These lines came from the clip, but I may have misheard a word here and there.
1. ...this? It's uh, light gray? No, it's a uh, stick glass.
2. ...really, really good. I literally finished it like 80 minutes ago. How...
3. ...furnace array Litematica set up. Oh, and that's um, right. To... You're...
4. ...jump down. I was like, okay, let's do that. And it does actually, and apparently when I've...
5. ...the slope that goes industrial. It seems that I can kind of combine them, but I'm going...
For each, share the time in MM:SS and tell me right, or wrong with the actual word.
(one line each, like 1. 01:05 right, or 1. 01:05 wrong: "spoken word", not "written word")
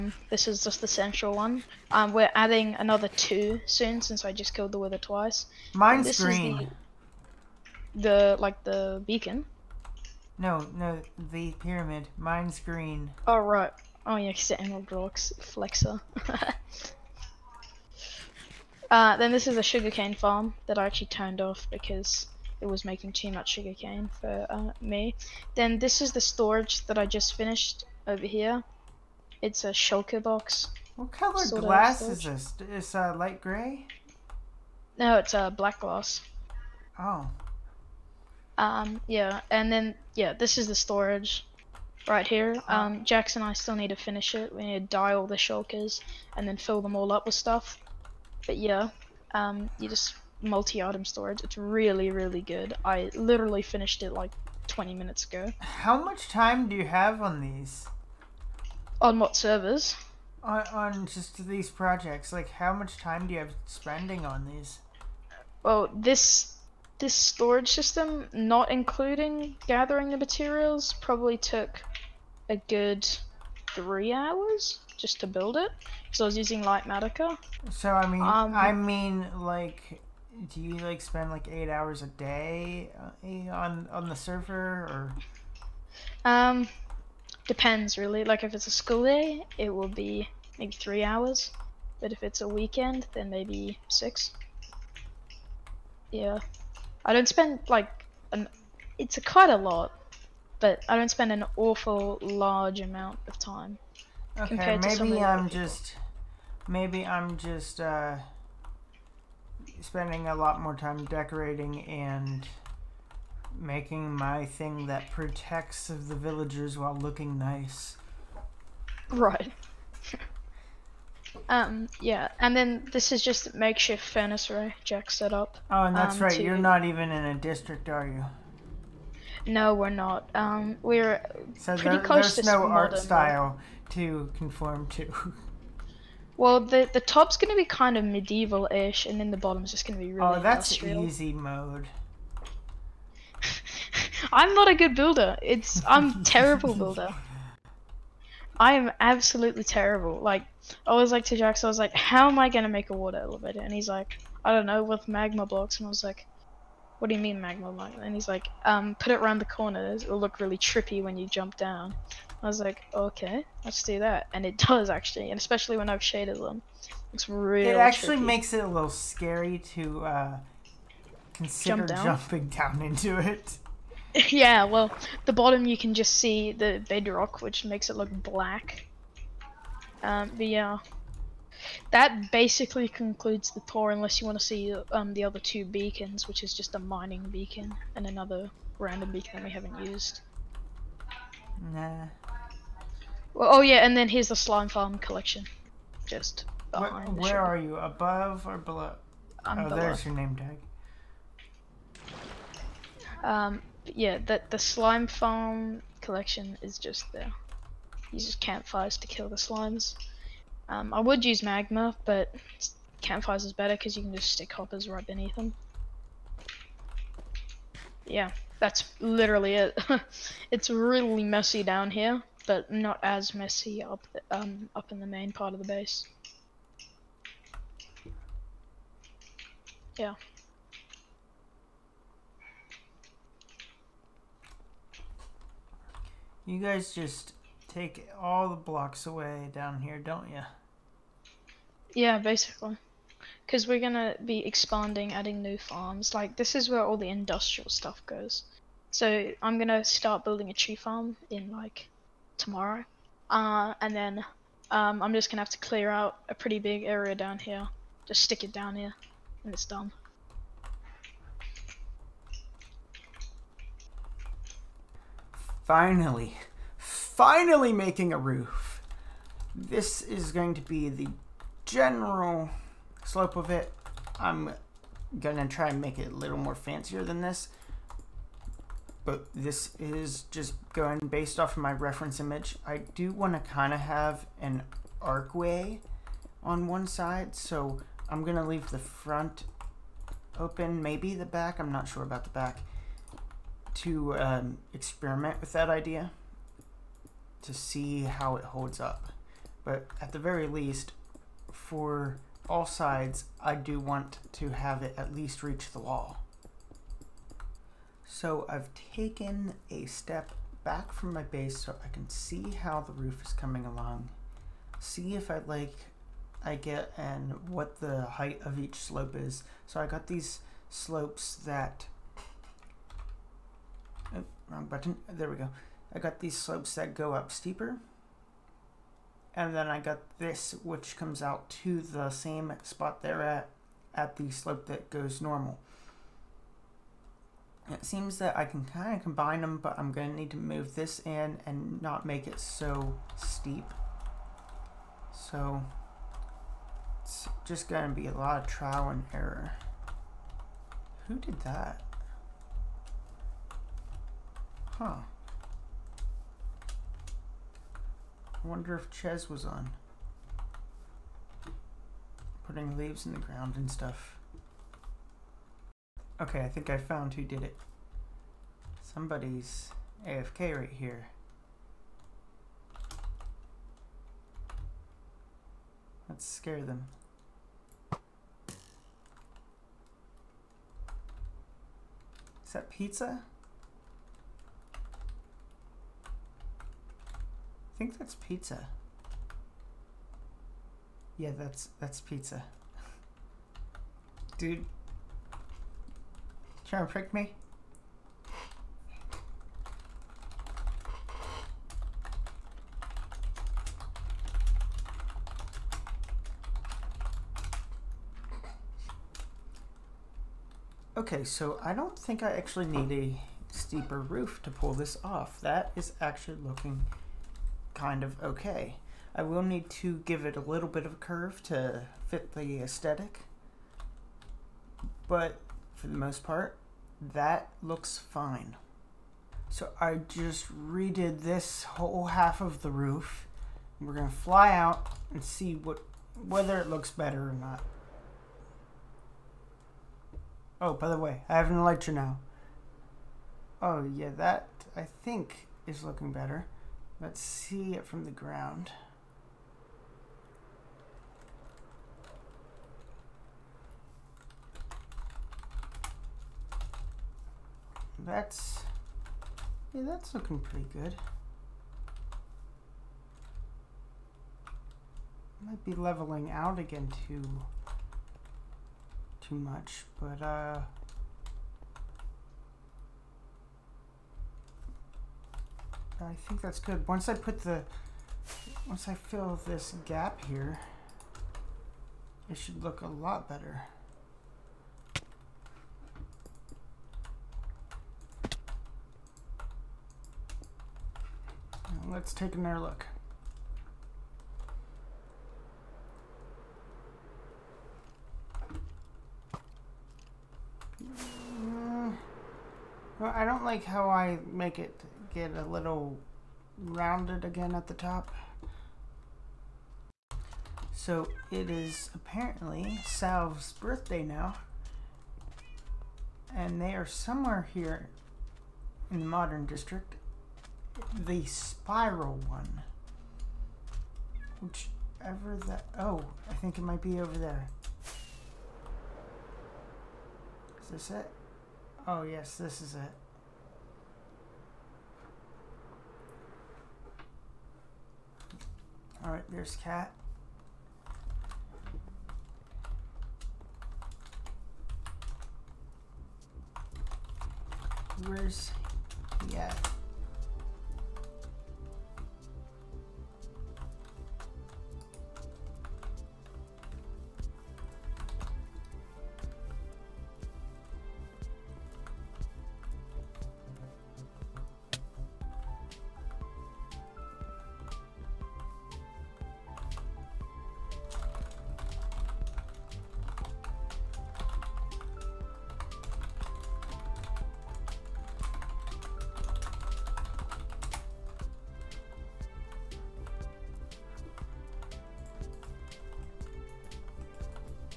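1. 00:32 wrong: "black", not "stick"
2. 00:51 wrong: "20", not "80"
3. 02:04 wrong: "Jack", not "Litematica"
4. 02:41 wrong: "especially", not "apparently"
5. 05:34 wrong: "normal", not "industrial".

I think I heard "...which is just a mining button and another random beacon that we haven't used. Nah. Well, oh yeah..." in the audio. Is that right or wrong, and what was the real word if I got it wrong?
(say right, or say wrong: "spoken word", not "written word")
wrong: "beacon", not "button".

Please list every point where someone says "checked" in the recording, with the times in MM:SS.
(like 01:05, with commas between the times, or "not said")
not said.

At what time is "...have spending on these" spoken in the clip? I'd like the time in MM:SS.
01:03.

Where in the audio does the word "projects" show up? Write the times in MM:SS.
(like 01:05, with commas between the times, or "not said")
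01:01.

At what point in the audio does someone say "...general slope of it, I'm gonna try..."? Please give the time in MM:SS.
04:31.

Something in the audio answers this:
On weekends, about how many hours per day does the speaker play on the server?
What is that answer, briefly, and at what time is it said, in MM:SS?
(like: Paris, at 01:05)
6, at 01:33.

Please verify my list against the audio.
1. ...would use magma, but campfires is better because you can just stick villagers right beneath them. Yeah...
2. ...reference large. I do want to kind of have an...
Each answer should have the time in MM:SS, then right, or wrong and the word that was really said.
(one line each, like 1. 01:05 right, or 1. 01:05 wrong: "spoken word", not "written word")
1. 03:31 wrong: "hoppers", not "villagers"
2. 04:41 wrong: "image", not "large".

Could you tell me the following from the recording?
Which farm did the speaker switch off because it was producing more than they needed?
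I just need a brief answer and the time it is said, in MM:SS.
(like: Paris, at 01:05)
Sugarcane farm, at 00:19.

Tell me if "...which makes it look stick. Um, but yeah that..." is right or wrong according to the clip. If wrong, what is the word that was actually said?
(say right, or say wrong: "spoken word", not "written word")
wrong: "black", not "stick".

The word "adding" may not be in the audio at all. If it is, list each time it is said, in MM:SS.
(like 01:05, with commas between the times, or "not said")
00:02, 04:05.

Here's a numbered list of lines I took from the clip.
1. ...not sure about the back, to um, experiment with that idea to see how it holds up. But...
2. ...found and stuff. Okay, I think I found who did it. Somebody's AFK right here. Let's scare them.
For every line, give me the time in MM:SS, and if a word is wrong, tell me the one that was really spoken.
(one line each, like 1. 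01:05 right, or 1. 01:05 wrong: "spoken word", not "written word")
1. 04:51 right
2. 06:03 wrong: "ground", not "found".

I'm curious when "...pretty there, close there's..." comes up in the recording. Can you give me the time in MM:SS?
02:11.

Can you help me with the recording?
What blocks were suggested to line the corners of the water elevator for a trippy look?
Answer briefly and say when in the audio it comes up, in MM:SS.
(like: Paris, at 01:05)
Magma blocks, at 02:35.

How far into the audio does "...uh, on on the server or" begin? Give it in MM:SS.
01:23.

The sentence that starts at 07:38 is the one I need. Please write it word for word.
That's, yeah, that's looking pretty good.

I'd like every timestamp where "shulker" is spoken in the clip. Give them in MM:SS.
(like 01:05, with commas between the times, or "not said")
00:29, 00:45.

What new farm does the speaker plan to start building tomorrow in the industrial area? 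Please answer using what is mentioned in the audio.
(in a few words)
Tree farm.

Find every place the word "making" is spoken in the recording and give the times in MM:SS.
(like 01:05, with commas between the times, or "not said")
00:22, 01:53, 04:27.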